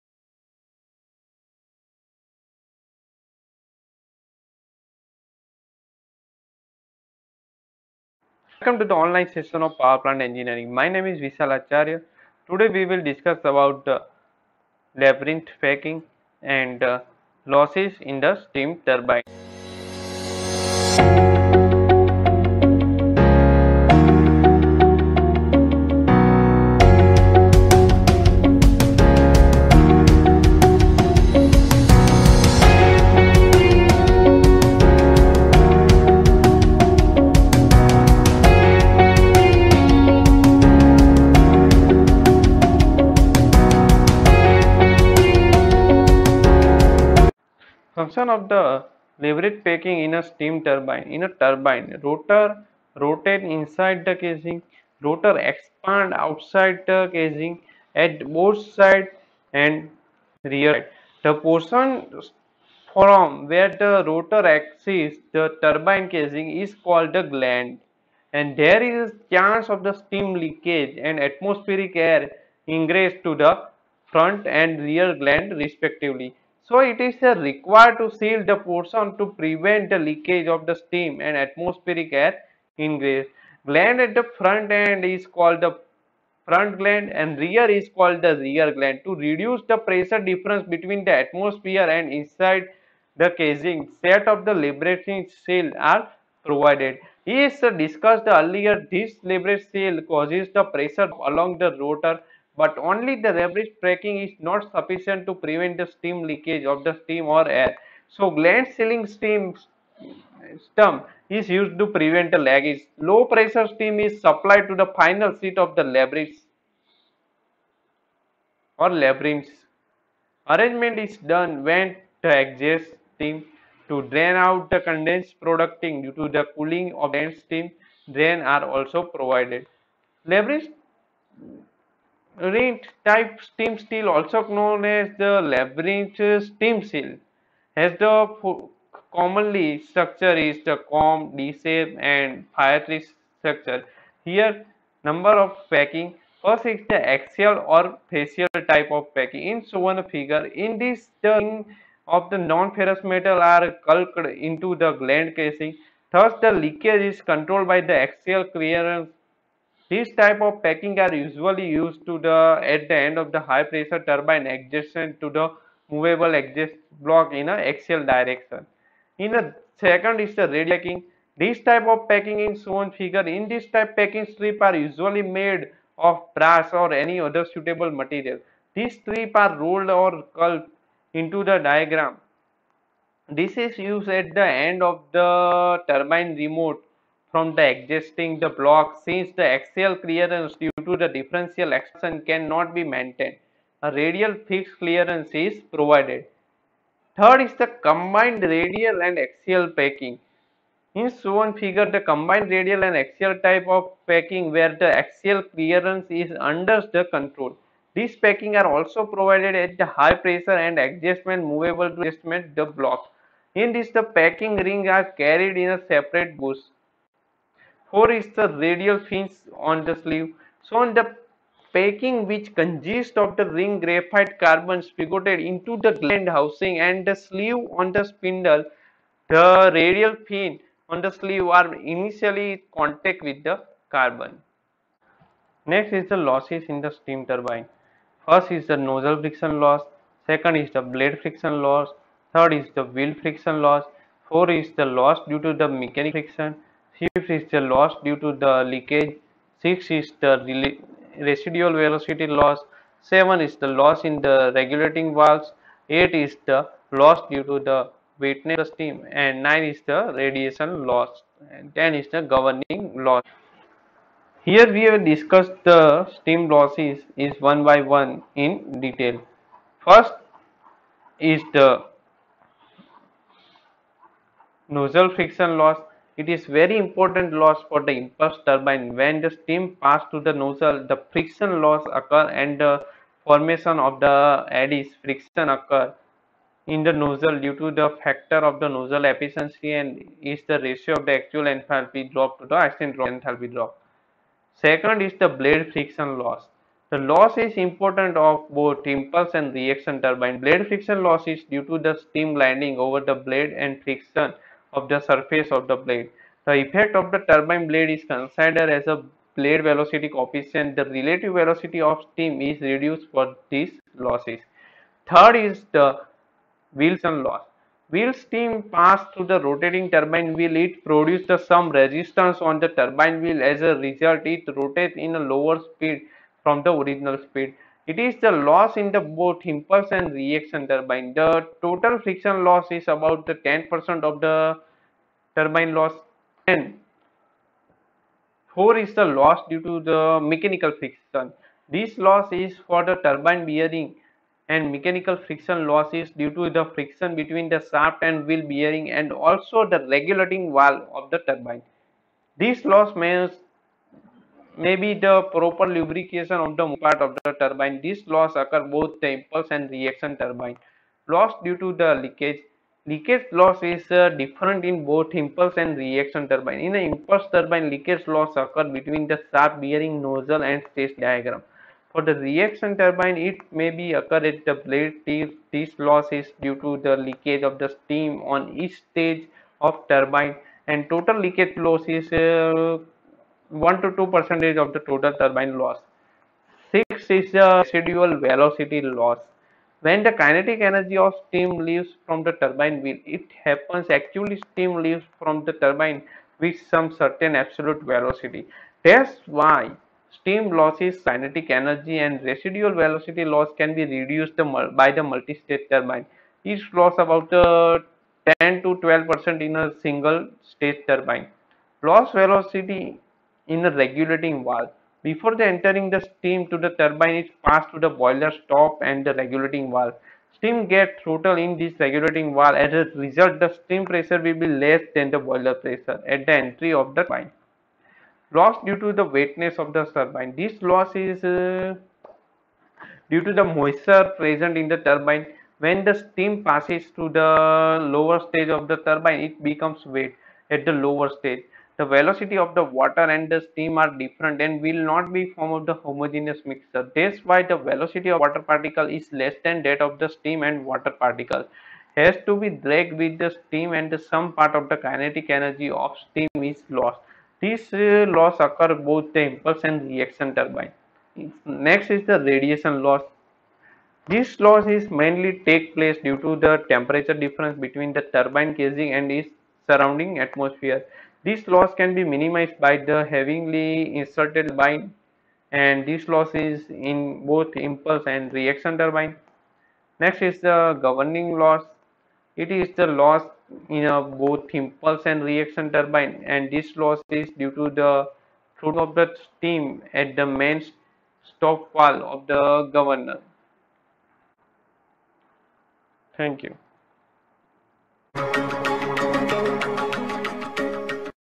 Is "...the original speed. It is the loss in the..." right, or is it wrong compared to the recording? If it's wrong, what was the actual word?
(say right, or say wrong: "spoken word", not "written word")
right.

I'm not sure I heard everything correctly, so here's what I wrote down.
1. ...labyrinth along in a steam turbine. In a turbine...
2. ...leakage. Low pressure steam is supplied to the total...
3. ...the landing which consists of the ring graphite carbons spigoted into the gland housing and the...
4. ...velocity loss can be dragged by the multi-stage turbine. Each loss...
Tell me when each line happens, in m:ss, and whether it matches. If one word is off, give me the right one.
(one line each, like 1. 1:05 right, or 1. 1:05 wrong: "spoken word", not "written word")
1. 0:49 wrong: "packing", not "along"
2. 1:52 wrong: "final", not "total"
3. 3:40 wrong: "packing", not "landing"
4. 6:42 wrong: "reduced", not "dragged".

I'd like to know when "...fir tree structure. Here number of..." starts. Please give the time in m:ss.
2:22.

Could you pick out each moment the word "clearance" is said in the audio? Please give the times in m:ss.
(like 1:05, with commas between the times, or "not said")
2:38, 3:10, 3:14, 3:25.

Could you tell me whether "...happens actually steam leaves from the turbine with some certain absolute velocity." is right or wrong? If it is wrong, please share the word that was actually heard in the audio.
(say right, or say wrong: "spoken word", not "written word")
right.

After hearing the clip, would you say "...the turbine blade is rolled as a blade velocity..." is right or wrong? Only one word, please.
wrong.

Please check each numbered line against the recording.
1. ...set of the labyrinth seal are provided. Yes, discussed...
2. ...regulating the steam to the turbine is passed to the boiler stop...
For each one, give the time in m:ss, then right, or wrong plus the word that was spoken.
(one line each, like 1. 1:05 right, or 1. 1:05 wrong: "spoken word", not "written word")
1. 1:34 right
2. 6:55 wrong: "entering", not "regulating".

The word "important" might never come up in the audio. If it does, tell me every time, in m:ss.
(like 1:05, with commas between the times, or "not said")
4:36, 4:57.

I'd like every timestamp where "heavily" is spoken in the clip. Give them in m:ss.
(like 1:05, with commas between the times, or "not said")
7:53.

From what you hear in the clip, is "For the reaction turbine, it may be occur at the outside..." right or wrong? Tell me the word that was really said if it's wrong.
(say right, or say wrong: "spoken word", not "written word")
wrong: "blade", not "outside".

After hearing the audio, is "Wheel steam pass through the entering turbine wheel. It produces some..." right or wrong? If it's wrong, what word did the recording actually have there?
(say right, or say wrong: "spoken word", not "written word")
wrong: "rotating", not "entering".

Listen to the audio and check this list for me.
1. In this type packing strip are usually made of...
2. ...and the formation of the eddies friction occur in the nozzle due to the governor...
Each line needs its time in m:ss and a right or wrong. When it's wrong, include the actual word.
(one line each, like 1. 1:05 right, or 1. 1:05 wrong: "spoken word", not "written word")
1. 2:53 right
2. 4:42 wrong: "factor", not "governor".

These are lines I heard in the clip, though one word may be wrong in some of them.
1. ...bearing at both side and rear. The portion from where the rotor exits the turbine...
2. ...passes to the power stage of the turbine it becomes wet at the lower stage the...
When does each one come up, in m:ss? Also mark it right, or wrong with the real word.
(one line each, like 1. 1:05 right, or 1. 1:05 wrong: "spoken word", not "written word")
1. 0:57 wrong: "casing", not "bearing"
2. 7:16 wrong: "lower", not "power".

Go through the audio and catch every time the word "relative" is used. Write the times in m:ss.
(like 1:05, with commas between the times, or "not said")
5:10.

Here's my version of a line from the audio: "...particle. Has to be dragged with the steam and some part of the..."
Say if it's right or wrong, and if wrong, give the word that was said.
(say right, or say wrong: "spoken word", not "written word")
right.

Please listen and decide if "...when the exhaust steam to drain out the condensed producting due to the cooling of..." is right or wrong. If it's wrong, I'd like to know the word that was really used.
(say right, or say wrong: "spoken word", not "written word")
right.